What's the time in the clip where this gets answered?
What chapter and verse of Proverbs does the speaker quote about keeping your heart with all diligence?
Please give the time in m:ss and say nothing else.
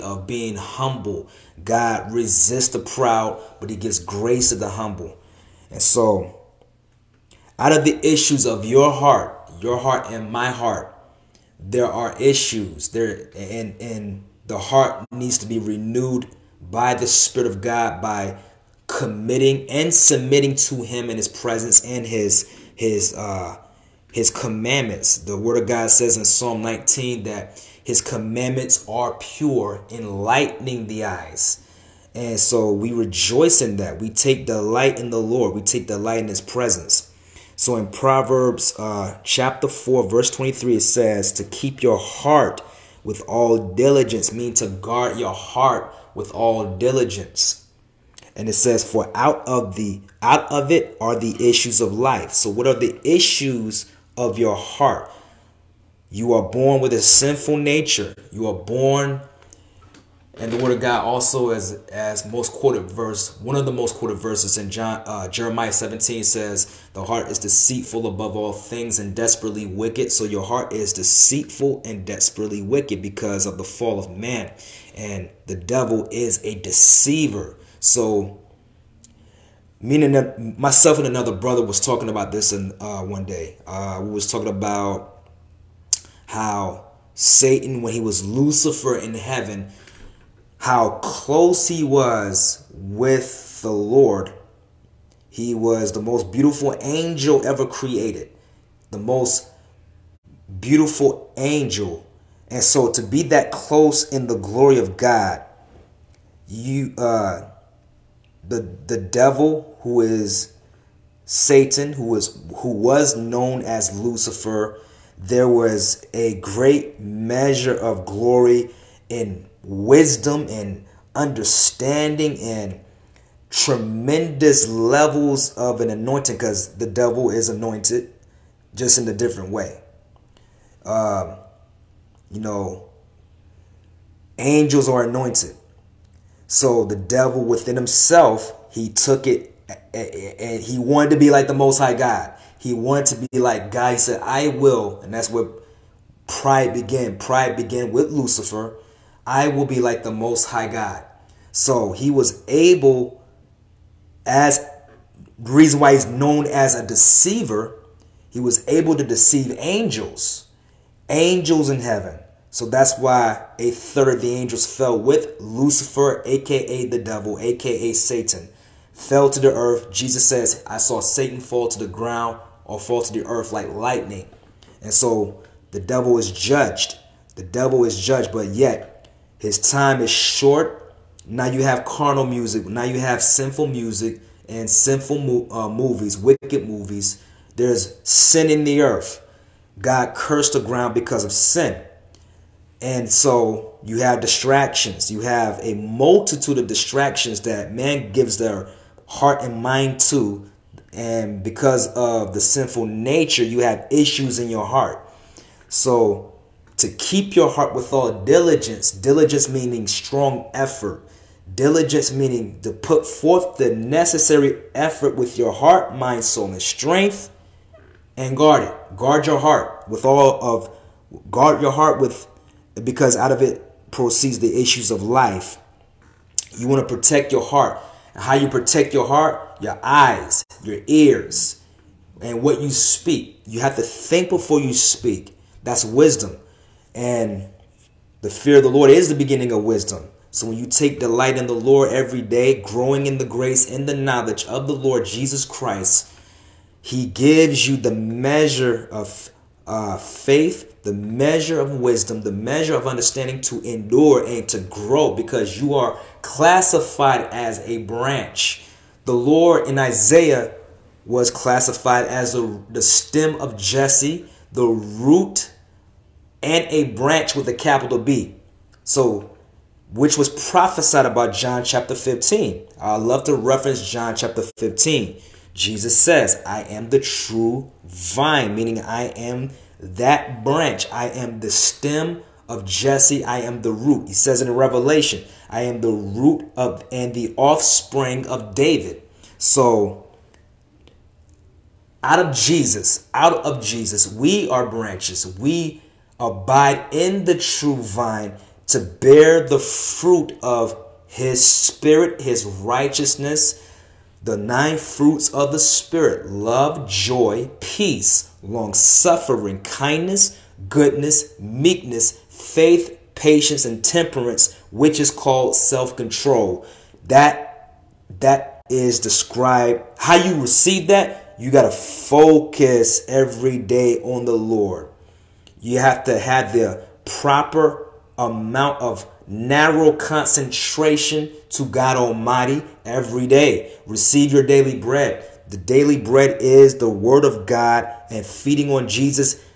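0:39.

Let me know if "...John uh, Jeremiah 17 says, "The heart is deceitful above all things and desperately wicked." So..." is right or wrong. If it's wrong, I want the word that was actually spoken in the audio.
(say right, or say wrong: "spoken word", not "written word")
right.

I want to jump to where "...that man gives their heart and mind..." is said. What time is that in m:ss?
3:17.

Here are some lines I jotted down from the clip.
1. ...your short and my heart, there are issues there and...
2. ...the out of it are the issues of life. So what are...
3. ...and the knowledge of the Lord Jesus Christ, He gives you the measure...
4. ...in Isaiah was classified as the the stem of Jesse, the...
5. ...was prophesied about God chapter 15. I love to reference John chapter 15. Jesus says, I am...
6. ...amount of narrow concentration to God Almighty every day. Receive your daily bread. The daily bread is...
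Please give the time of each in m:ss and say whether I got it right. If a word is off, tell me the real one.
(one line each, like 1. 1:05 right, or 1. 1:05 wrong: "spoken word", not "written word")
1. 0:09 wrong: "heart", not "short"
2. 0:49 right
3. 4:03 right
4. 4:19 right
5. 4:30 wrong: "John", not "God"
6. 5:28 right.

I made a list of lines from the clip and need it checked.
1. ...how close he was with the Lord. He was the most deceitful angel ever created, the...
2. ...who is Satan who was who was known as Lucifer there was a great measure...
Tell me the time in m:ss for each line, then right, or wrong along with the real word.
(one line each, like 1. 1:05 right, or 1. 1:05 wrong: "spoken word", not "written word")
1. 1:30 wrong: "beautiful", not "deceitful"
2. 1:49 right.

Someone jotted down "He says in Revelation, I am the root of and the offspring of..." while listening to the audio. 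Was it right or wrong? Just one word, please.
right.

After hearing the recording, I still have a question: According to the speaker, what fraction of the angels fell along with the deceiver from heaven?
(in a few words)
A third.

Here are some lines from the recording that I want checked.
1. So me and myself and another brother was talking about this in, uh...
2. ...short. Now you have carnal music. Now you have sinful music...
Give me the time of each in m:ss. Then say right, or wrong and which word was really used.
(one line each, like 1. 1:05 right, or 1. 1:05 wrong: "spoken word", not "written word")
1. 1:17 right
2. 3:00 right.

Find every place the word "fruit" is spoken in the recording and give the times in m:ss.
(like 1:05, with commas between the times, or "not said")
4:59, 5:04.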